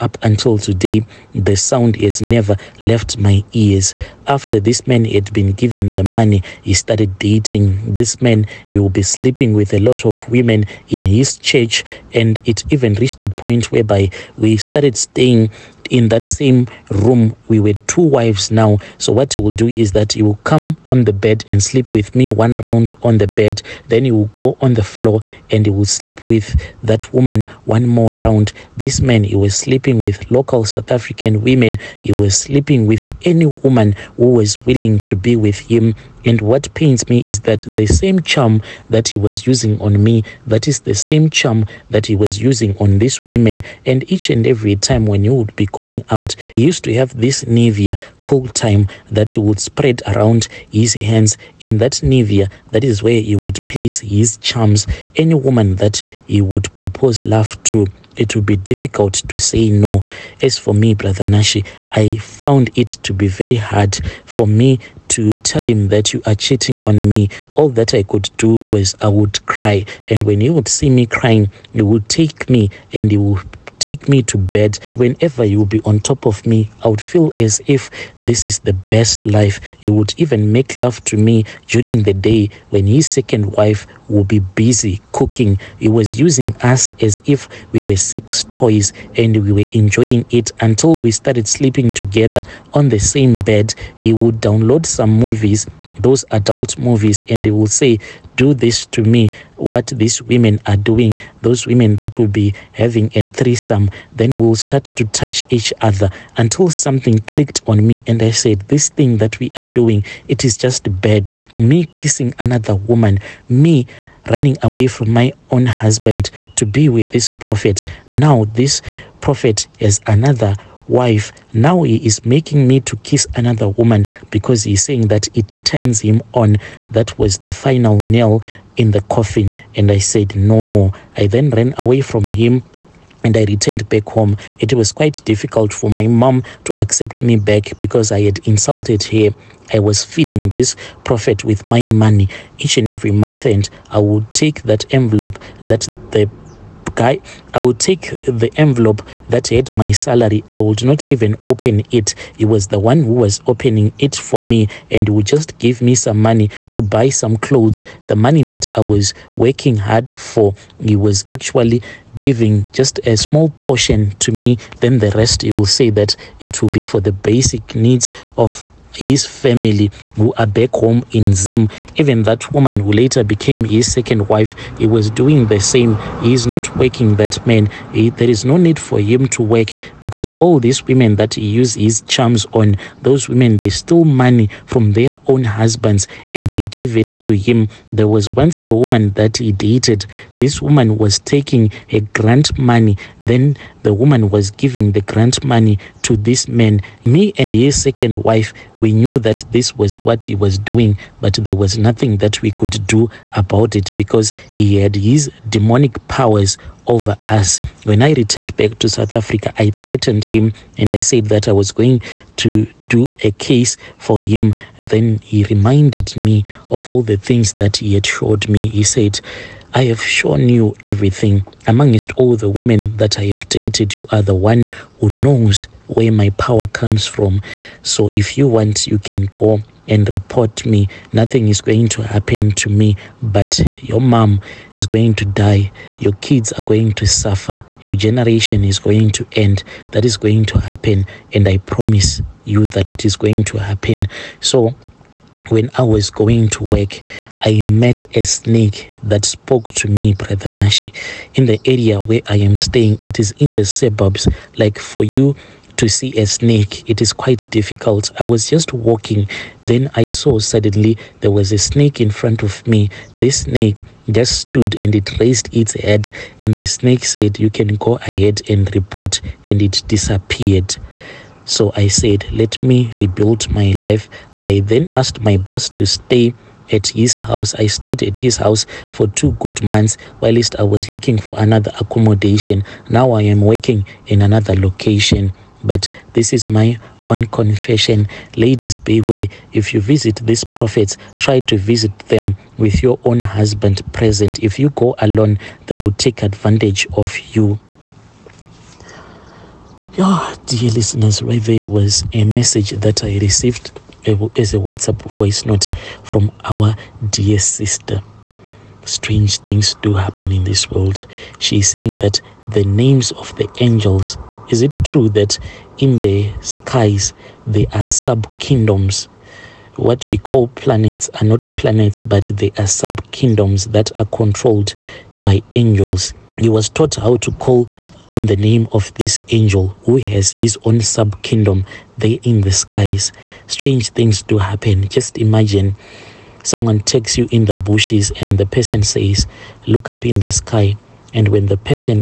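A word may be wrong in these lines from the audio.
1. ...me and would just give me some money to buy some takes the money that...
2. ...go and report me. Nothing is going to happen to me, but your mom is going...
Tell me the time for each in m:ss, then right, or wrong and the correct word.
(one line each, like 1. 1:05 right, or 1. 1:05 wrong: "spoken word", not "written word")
1. 2:34 wrong: "clothes", not "takes"
2. 3:49 right.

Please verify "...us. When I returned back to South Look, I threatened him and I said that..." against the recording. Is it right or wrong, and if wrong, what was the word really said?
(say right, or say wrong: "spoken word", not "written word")
wrong: "Africa", not "Look".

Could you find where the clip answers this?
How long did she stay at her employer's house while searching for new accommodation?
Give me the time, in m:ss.
4:39.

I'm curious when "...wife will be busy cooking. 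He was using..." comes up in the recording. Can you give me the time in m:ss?
1:23.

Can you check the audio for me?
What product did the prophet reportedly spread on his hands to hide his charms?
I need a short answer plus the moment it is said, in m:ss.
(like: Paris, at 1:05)
Nivea cool time, at 0:47.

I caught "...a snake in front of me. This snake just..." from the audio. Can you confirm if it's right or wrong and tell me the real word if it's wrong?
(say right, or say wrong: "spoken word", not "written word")
right.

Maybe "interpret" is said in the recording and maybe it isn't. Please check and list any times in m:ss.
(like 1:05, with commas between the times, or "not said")
not said.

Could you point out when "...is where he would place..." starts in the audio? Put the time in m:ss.
0:52.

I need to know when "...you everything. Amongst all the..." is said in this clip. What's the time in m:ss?
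3:40.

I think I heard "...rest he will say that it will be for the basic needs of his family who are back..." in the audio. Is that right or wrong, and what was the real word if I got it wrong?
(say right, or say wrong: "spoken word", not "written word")
right.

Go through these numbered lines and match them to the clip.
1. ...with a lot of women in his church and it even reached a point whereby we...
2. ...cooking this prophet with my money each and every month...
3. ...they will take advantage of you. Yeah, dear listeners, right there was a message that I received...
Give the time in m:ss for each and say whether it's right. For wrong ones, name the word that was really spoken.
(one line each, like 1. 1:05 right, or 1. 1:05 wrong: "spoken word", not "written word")
1. 0:09 right
2. 2:20 wrong: "feeding", not "cooking"
3. 4:55 right.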